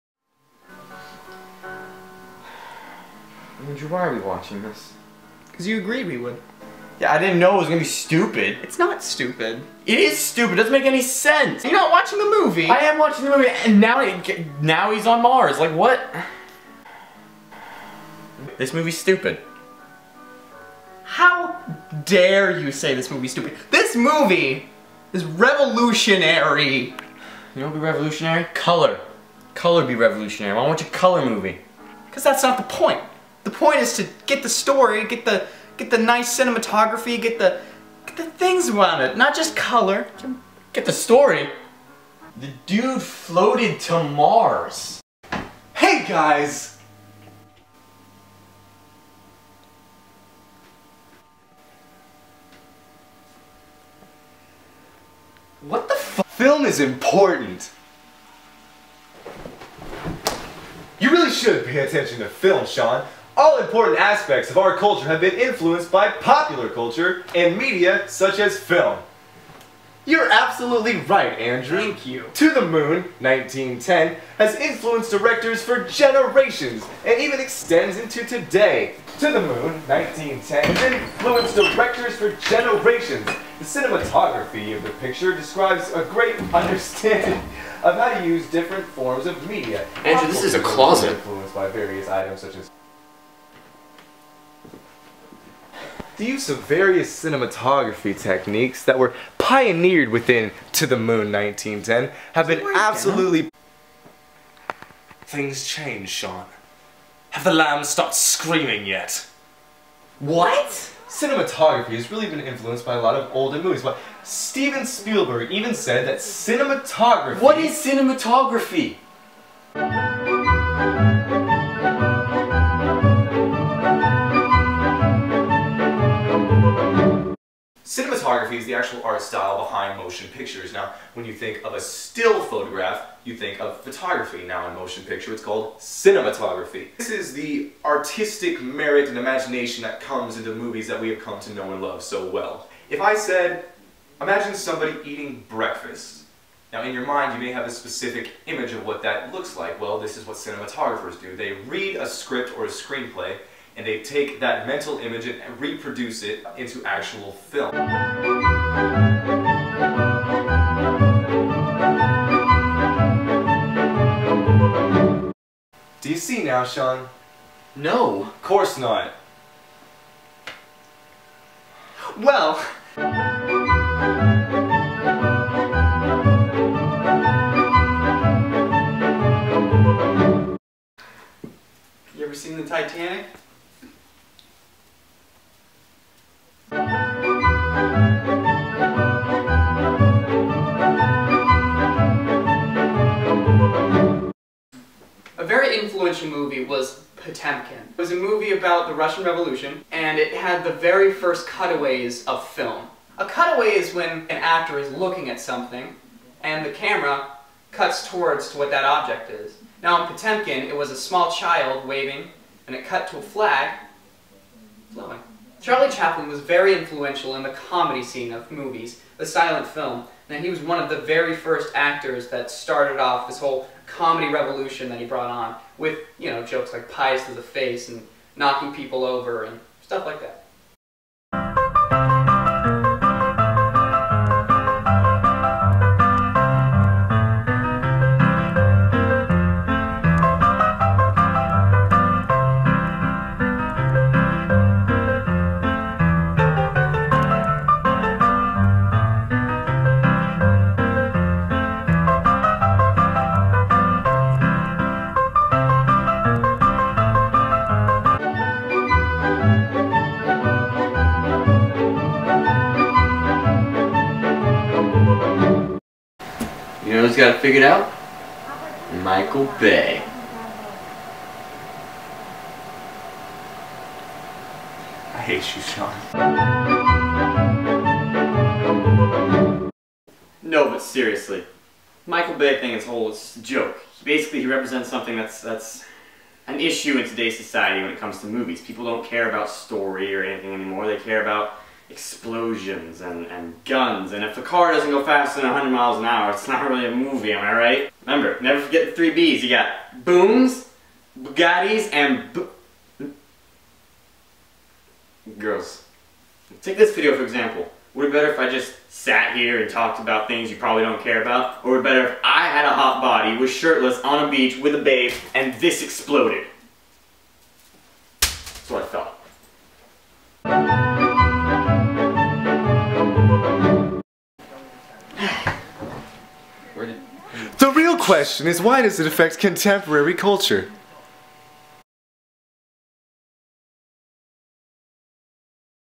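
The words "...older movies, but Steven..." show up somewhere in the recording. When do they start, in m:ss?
1:53.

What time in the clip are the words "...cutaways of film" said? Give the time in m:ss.
3:21.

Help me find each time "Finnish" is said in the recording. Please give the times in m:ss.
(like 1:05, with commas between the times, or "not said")
not said.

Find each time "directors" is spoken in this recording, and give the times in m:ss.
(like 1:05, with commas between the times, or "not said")
1:15, 1:21.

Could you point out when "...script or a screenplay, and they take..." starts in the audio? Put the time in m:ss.
2:32.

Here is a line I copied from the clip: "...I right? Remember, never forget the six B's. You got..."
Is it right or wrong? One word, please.
wrong.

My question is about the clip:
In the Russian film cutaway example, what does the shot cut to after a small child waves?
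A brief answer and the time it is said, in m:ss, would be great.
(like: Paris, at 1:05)
A flag, at 3:33.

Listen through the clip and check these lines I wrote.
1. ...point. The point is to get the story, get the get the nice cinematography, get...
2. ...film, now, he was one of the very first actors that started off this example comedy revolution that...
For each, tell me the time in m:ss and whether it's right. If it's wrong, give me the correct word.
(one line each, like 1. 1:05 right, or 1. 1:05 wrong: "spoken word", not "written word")
1. 0:32 right
2. 3:39 wrong: "whole", not "example".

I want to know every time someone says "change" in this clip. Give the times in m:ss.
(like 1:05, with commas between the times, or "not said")
1:45.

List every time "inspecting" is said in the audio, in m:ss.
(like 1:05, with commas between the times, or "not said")
not said.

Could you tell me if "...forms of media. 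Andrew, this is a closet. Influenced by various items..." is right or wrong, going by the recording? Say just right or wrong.
right.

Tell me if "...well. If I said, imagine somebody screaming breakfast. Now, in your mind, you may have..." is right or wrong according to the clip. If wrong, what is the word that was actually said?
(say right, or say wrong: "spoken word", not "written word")
wrong: "eating", not "screaming".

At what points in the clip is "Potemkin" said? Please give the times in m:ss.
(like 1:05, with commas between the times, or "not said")
3:17, 3:30.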